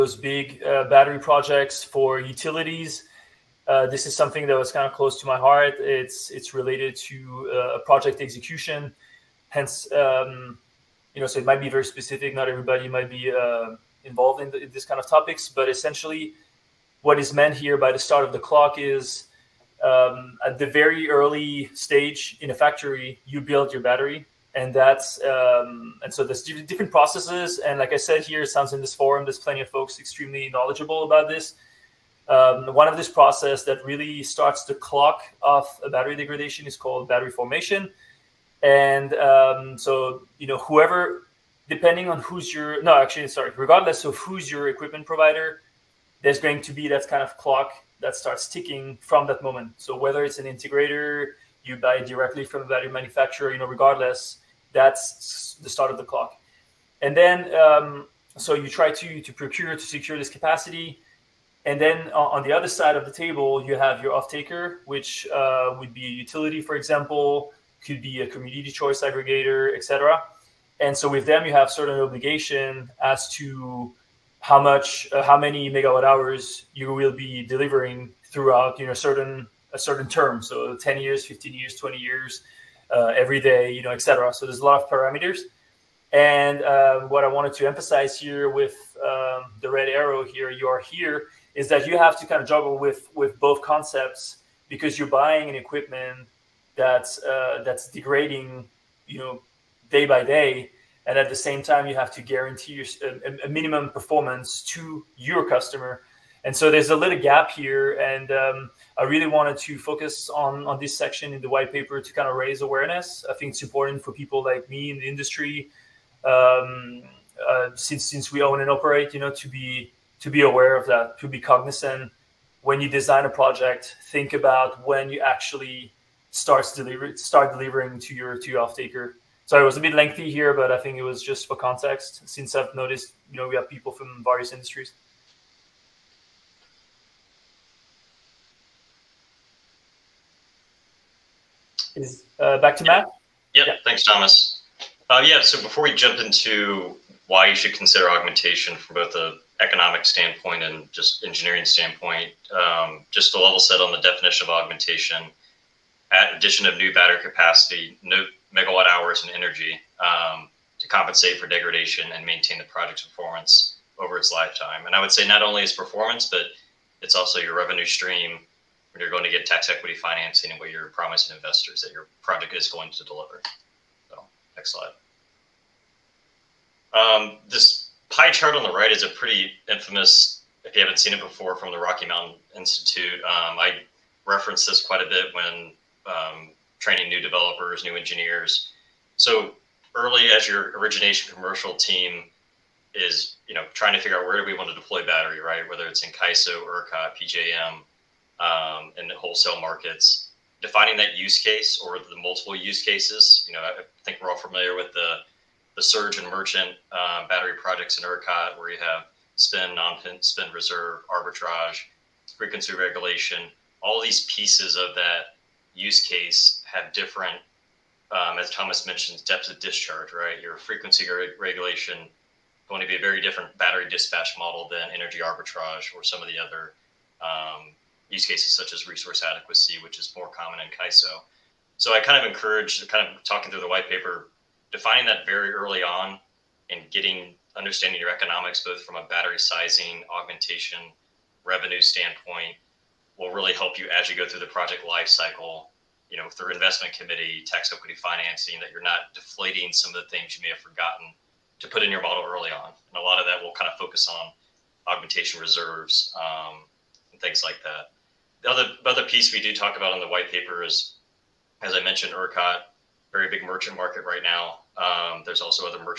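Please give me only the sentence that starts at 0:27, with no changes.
And like I said here, it sounds in this forum, there's plenty of folks extremely knowledgeable about this.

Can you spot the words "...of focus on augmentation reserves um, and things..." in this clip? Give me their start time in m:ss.
4:13.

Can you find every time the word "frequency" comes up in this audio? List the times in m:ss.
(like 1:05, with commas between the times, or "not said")
3:32, 3:40.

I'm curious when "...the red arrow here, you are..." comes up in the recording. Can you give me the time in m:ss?
1:29.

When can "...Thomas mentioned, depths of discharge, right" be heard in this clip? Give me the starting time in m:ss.
3:38.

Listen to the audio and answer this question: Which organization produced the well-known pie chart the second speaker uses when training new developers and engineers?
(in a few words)
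Rocky Mountain Institute.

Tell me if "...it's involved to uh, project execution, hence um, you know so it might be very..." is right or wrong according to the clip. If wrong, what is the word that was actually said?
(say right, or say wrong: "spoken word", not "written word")
wrong: "related", not "involved".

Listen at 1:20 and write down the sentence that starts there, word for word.
So 10 years, 15 years, 20 years, uh, every day, you know, etc.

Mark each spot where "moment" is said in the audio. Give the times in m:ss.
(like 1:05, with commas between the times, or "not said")
0:49.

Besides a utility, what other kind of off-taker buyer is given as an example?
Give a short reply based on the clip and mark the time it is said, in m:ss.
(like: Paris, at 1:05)
Community choice aggregator, at 1:08.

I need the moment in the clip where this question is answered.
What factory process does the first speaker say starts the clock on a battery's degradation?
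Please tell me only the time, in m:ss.
0:37.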